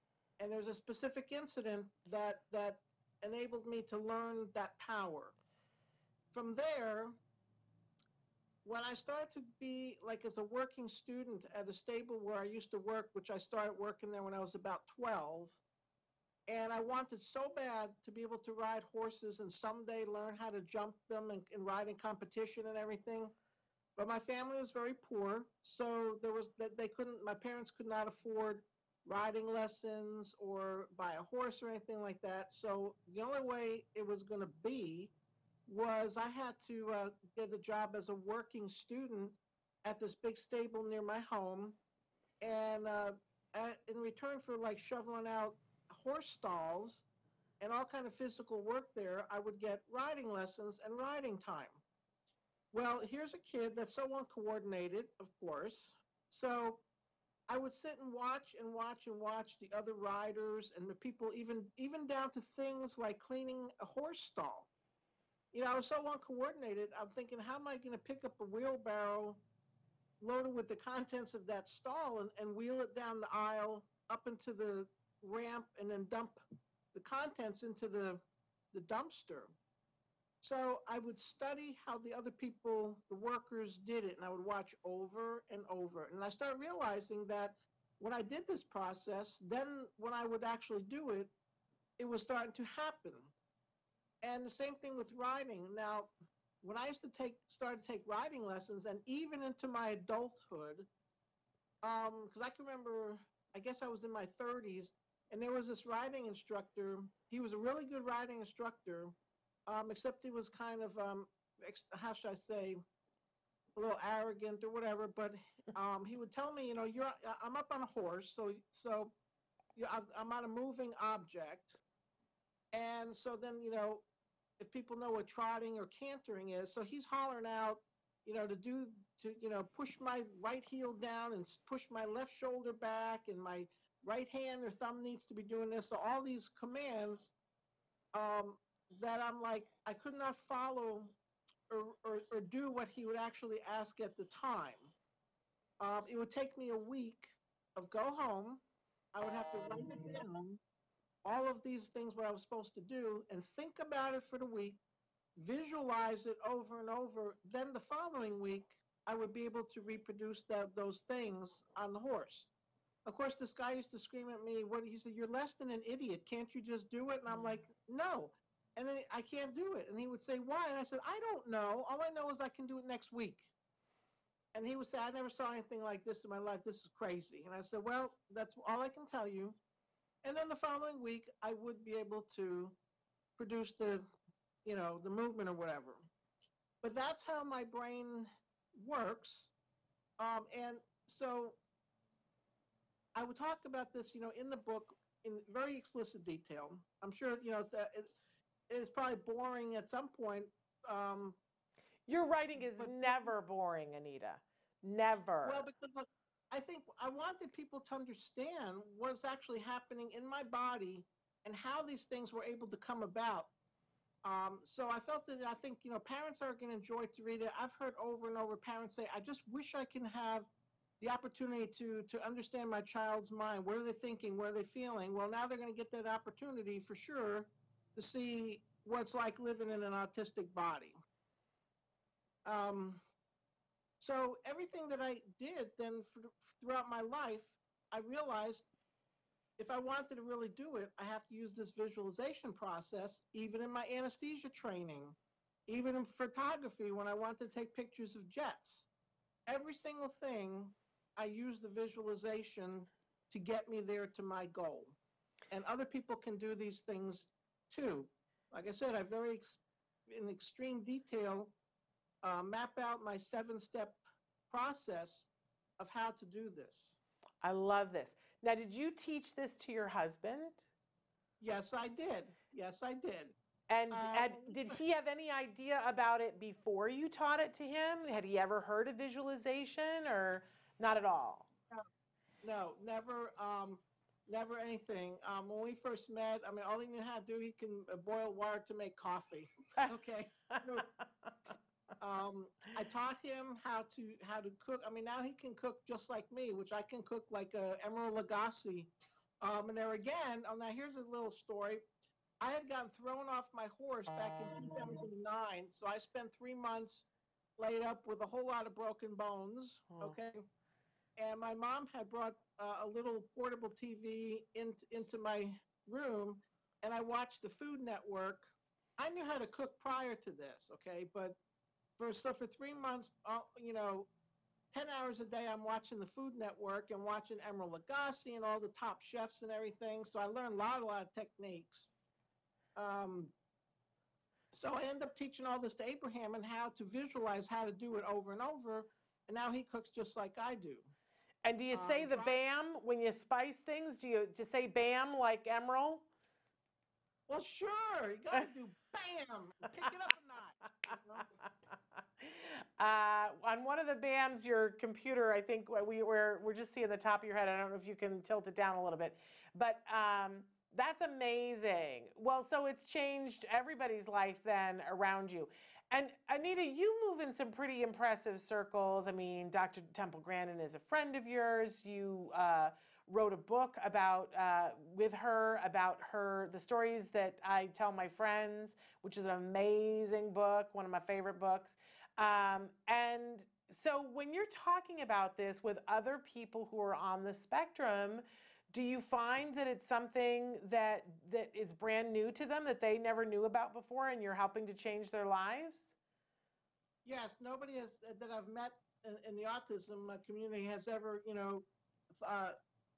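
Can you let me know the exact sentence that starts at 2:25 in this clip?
Um, it would take me a week of go home.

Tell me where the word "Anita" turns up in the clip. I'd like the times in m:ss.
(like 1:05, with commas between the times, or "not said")
3:23, 6:06.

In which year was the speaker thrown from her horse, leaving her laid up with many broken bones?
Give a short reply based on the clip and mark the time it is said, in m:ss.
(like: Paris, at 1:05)
2009, at 5:04.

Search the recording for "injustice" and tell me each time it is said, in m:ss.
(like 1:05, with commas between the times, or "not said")
not said.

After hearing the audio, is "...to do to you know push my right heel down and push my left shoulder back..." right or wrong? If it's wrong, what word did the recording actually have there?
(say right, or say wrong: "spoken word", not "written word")
right.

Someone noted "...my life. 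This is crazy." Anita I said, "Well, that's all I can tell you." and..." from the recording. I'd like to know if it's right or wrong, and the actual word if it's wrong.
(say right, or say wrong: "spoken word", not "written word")
wrong: "And", not "Anita".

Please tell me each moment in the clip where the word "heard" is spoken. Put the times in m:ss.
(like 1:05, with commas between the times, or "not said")
3:37, 4:38.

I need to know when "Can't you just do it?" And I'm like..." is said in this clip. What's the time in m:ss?
2:46.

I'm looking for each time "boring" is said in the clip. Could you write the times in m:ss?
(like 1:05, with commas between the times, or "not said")
3:19, 3:23.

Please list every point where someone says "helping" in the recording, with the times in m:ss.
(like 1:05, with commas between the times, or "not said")
6:34.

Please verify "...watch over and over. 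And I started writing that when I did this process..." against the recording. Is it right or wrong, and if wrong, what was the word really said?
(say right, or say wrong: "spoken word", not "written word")
wrong: "realizing", not "writing".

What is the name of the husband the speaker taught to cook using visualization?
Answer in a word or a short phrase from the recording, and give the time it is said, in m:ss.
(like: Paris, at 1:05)
Abraham, at 5:35.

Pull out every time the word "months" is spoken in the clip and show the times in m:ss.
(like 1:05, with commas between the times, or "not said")
5:06, 5:22.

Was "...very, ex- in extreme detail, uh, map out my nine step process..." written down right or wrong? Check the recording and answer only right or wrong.
wrong.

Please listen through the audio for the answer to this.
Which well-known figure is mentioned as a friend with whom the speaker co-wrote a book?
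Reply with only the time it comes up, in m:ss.
6:09.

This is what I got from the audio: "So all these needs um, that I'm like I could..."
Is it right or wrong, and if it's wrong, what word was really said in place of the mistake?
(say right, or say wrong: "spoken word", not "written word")
wrong: "commands", not "needs".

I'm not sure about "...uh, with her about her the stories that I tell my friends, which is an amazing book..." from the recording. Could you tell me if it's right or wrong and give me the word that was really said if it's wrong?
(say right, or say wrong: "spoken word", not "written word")
right.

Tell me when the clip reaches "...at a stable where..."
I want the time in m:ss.
0:11.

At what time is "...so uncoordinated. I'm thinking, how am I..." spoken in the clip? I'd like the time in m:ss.
1:05.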